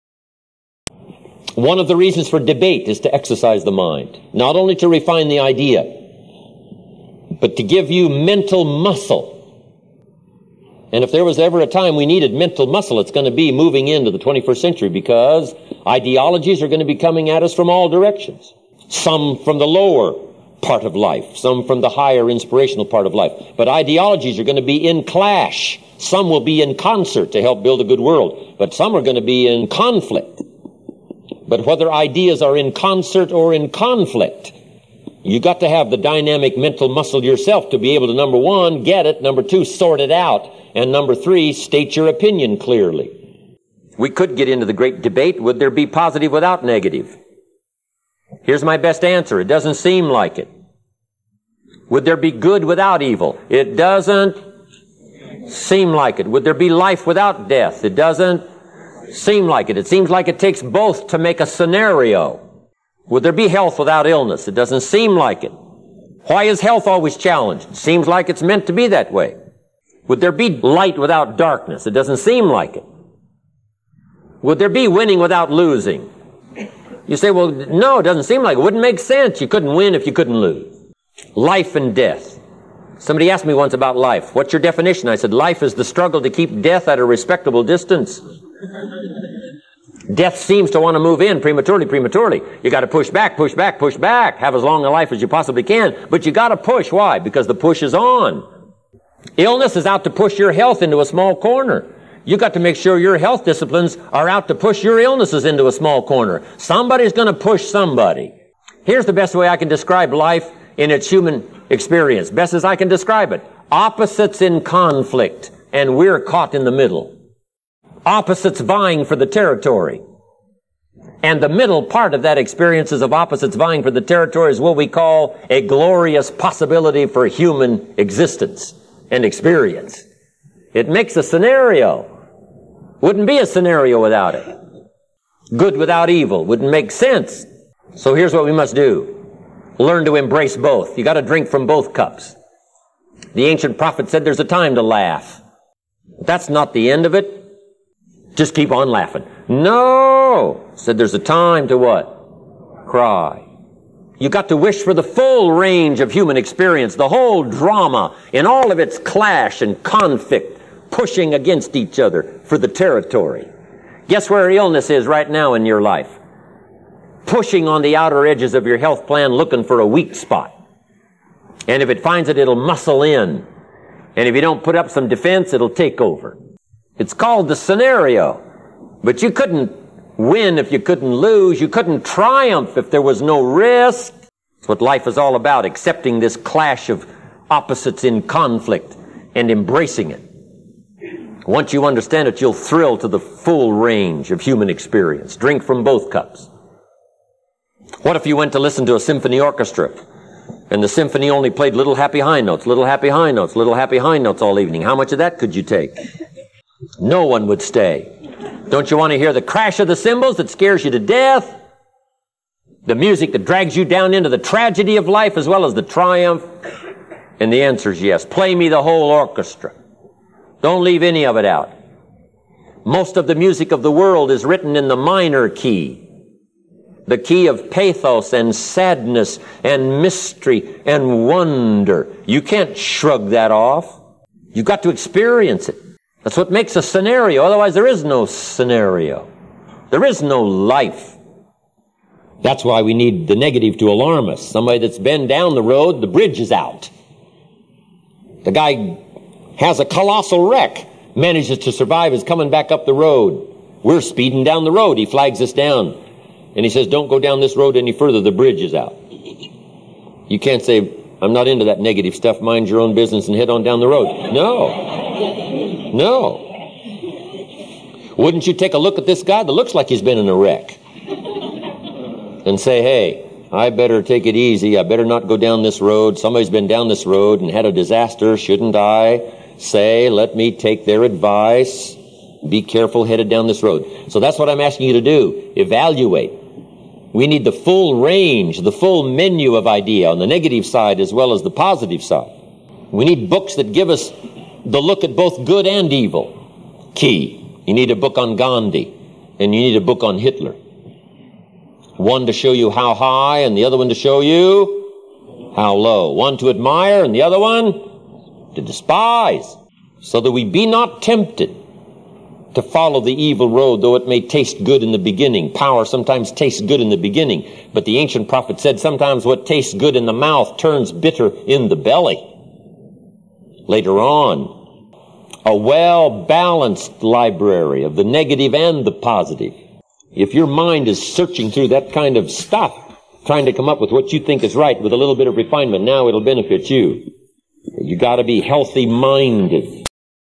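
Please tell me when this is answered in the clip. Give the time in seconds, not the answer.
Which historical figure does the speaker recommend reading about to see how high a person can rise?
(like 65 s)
298 s.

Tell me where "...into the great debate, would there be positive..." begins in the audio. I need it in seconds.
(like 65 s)
44 s.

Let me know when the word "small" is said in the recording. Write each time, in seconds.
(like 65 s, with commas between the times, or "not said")
101 s, 105 s.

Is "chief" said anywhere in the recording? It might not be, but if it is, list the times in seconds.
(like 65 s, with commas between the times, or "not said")
not said.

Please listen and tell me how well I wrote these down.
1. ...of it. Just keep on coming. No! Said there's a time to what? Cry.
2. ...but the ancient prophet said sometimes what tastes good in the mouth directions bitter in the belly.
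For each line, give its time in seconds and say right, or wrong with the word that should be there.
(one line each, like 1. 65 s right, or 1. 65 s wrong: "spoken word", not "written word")
1. 147 s wrong: "laughing", not "coming"
2. 317 s wrong: "turns", not "directions".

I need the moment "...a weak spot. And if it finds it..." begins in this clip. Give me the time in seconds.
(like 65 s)
169 s.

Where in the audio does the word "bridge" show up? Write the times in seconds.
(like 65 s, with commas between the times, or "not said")
246 s, 258 s.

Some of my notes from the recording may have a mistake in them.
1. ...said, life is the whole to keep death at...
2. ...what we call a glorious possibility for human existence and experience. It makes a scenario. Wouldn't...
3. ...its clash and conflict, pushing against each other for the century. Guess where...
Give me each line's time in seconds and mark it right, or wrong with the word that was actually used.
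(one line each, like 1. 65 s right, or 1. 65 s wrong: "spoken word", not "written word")
1. 85 s wrong: "struggle", not "whole"
2. 124 s right
3. 158 s wrong: "territory", not "century".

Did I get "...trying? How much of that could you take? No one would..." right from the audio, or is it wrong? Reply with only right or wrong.
wrong.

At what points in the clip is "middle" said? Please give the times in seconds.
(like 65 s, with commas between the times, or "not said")
116 s, 121 s.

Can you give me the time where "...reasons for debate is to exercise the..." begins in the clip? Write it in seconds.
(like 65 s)
1 s.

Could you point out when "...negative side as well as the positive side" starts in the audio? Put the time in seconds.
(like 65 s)
290 s.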